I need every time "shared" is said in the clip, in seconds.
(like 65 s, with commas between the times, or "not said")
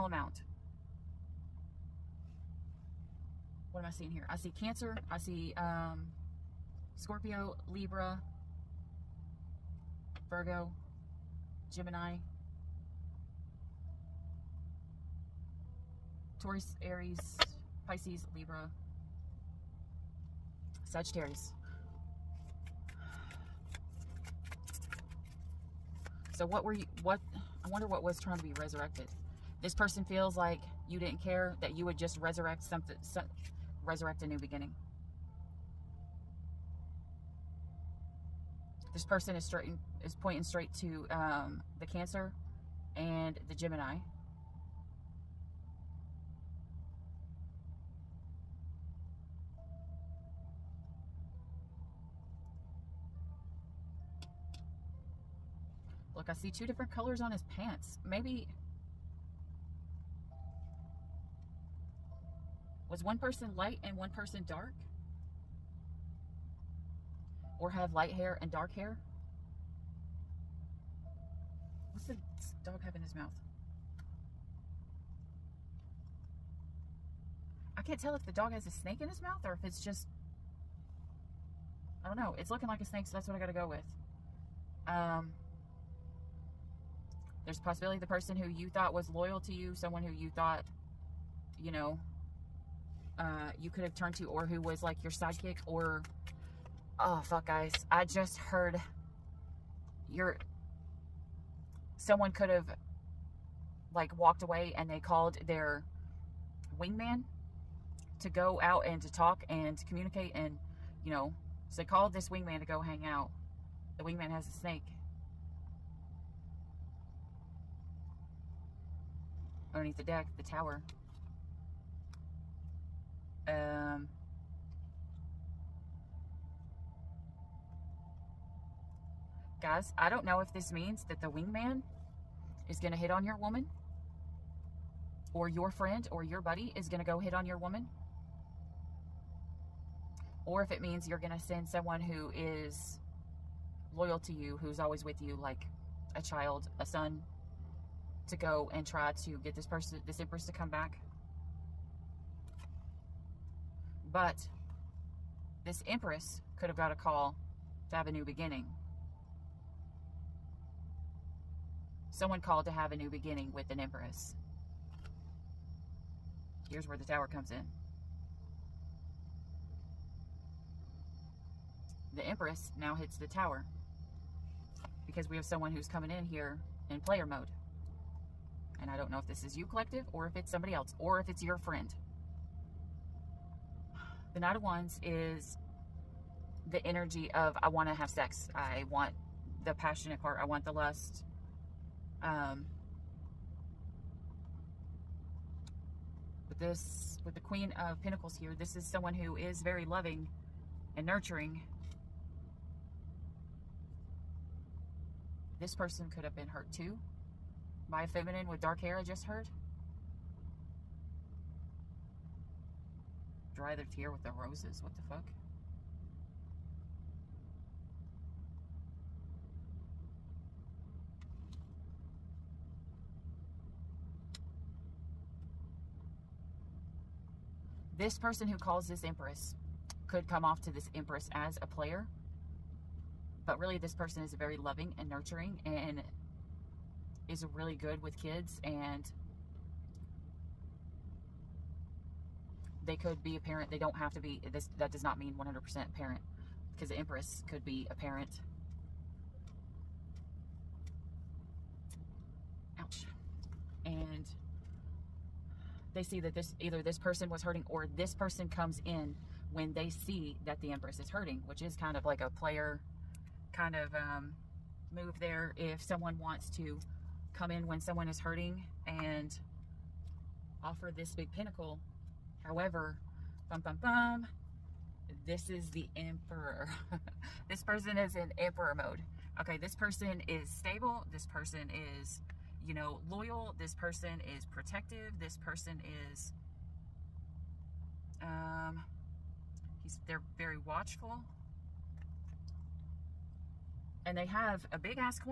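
not said.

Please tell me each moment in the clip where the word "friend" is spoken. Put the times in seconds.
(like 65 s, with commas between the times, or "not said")
135 s, 181 s.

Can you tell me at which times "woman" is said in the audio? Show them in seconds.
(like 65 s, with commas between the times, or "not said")
133 s, 137 s.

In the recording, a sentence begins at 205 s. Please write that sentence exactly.
This person could have been hurt too by a feminine with dark hair I just heard?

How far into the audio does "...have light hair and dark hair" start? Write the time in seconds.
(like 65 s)
67 s.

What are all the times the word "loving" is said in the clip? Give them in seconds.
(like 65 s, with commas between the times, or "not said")
199 s, 234 s.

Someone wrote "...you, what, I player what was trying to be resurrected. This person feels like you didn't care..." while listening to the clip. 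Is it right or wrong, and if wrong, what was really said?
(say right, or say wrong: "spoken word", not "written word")
wrong: "wonder", not "player".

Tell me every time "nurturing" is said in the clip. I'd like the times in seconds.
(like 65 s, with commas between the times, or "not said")
201 s, 235 s.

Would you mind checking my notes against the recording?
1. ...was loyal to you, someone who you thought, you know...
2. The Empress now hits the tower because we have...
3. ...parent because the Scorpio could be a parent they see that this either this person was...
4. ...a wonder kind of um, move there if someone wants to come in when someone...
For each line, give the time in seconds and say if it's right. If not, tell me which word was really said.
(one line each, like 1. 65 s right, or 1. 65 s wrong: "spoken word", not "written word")
1. 88 s right
2. 172 s right
3. 245 s wrong: "Empress", not "Scorpio"
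4. 262 s wrong: "player", not "wonder".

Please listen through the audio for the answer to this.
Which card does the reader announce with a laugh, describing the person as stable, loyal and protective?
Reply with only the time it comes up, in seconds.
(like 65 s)
275 s.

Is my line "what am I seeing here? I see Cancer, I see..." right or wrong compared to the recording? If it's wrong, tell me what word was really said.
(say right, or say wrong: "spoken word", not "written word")
right.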